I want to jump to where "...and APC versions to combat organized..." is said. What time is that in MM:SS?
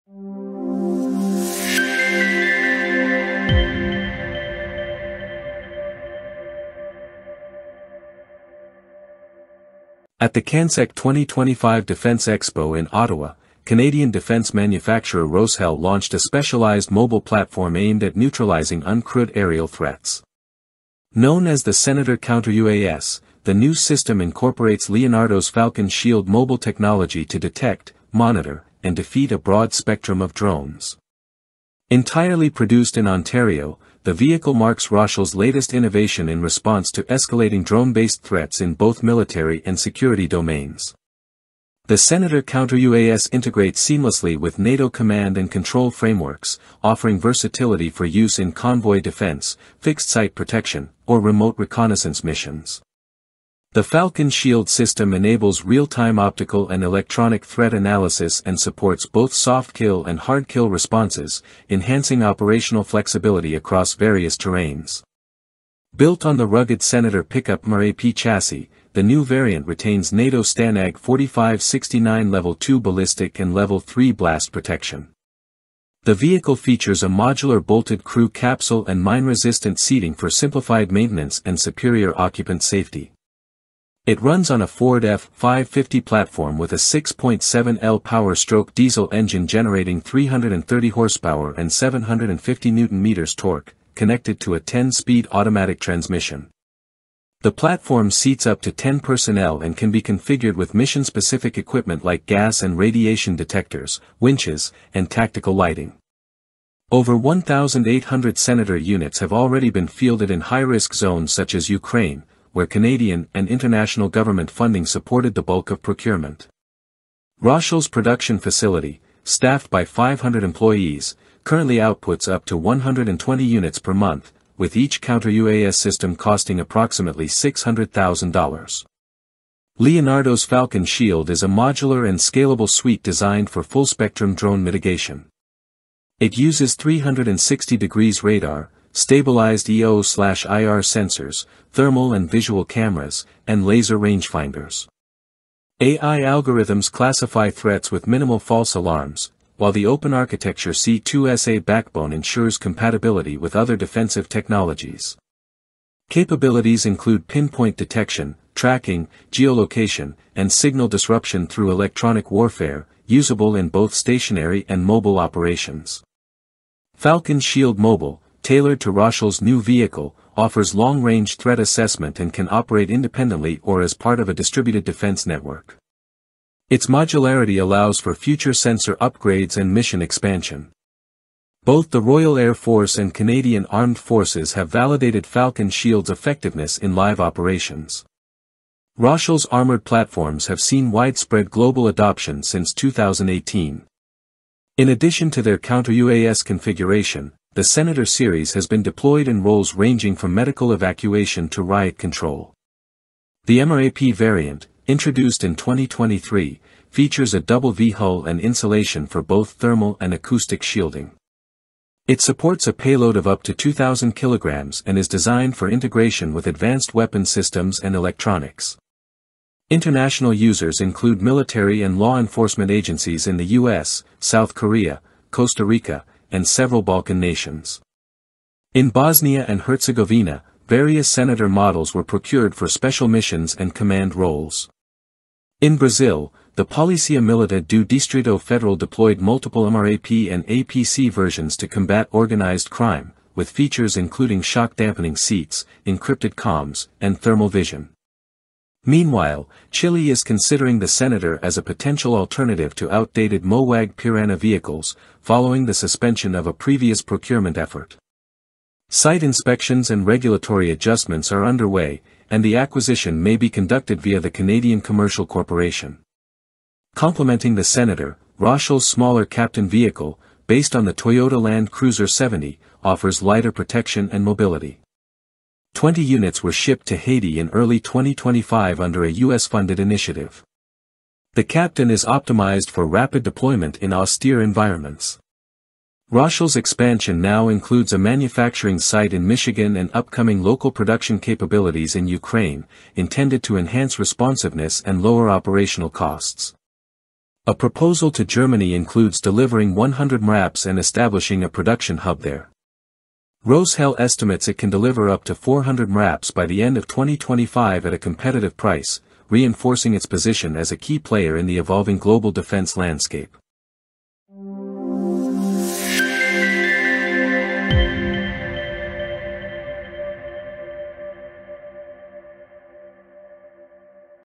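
04:00.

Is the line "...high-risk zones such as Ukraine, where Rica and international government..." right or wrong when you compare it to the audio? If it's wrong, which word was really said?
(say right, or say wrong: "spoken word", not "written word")
wrong: "Canadian", not "Rica".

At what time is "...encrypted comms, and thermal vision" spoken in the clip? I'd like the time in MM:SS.
04:05.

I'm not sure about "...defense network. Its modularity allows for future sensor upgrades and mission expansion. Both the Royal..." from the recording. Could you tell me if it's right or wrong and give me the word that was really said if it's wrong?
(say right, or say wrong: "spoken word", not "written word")
right.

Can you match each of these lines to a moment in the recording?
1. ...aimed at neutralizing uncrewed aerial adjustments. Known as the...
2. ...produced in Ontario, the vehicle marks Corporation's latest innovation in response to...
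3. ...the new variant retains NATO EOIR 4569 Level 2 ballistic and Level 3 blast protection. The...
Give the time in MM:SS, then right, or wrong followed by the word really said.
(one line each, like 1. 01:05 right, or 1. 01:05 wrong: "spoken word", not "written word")
1. 00:17 wrong: "threats", not "adjustments"
2. 00:32 wrong: "Roshel", not "Corporation"
3. 01:08 wrong: "STANAG", not "EOIR".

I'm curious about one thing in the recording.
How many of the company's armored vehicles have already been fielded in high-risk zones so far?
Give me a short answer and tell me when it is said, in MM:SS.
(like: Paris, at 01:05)
1,800, at 01:47.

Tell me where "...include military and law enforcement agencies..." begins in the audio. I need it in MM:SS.
03:40.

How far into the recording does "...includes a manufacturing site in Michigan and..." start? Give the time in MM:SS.
04:47.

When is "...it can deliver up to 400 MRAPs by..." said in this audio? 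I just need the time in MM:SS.
05:04.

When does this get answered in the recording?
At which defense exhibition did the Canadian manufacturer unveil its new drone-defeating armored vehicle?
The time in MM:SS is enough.
00:10.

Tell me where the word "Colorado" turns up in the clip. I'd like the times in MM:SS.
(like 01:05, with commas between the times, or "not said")
not said.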